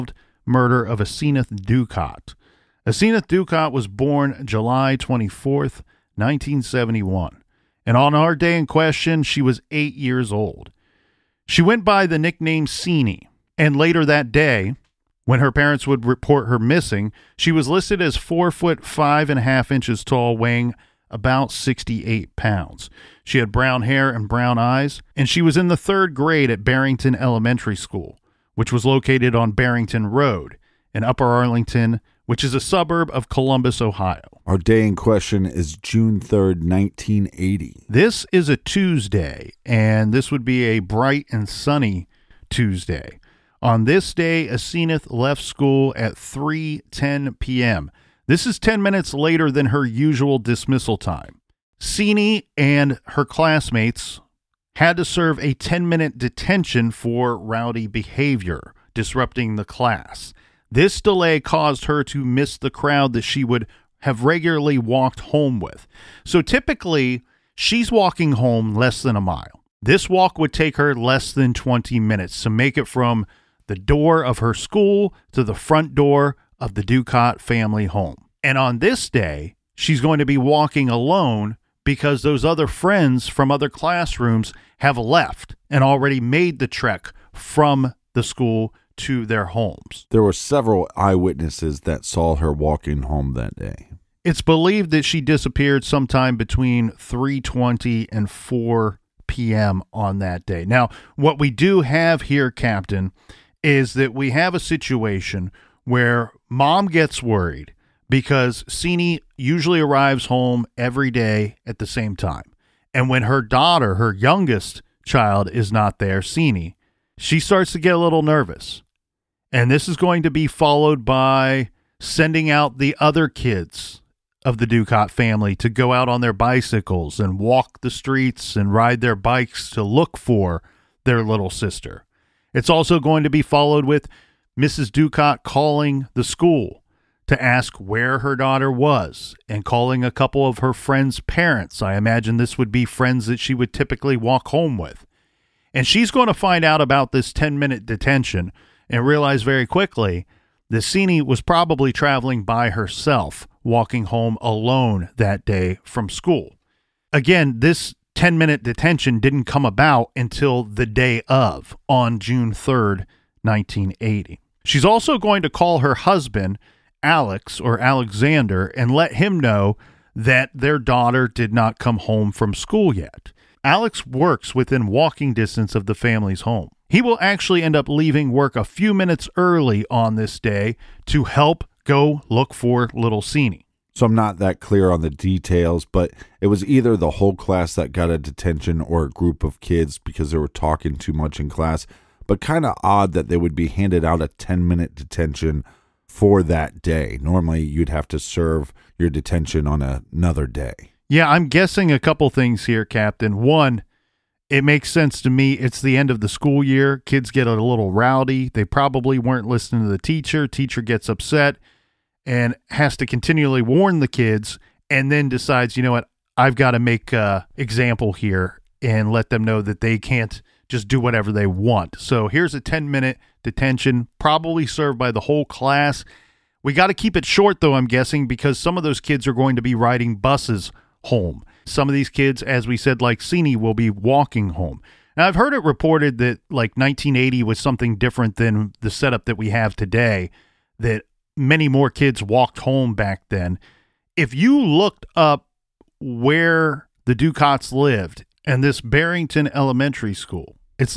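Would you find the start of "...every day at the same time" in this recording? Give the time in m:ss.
1:50.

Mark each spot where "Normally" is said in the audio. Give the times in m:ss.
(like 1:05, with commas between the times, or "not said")
3:17.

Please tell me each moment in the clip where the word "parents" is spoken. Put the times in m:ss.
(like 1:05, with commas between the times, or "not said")
0:15, 2:21.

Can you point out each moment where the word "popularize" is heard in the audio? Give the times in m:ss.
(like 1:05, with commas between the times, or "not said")
not said.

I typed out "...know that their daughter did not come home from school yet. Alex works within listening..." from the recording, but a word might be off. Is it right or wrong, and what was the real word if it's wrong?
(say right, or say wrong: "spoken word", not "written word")
wrong: "walking", not "listening".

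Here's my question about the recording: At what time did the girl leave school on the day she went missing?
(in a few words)
3:10 p.m.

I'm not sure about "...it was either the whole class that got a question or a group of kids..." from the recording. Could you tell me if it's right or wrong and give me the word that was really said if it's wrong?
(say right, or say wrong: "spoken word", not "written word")
wrong: "detention", not "question".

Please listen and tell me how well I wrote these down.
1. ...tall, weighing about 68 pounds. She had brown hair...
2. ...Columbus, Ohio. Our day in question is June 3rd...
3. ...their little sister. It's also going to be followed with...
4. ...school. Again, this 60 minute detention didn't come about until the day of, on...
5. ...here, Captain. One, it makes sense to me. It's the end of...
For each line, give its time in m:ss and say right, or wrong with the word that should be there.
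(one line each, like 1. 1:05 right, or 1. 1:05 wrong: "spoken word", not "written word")
1. 0:20 right
2. 0:33 right
3. 2:11 right
4. 2:36 wrong: "10", not "60"
5. 3:22 right.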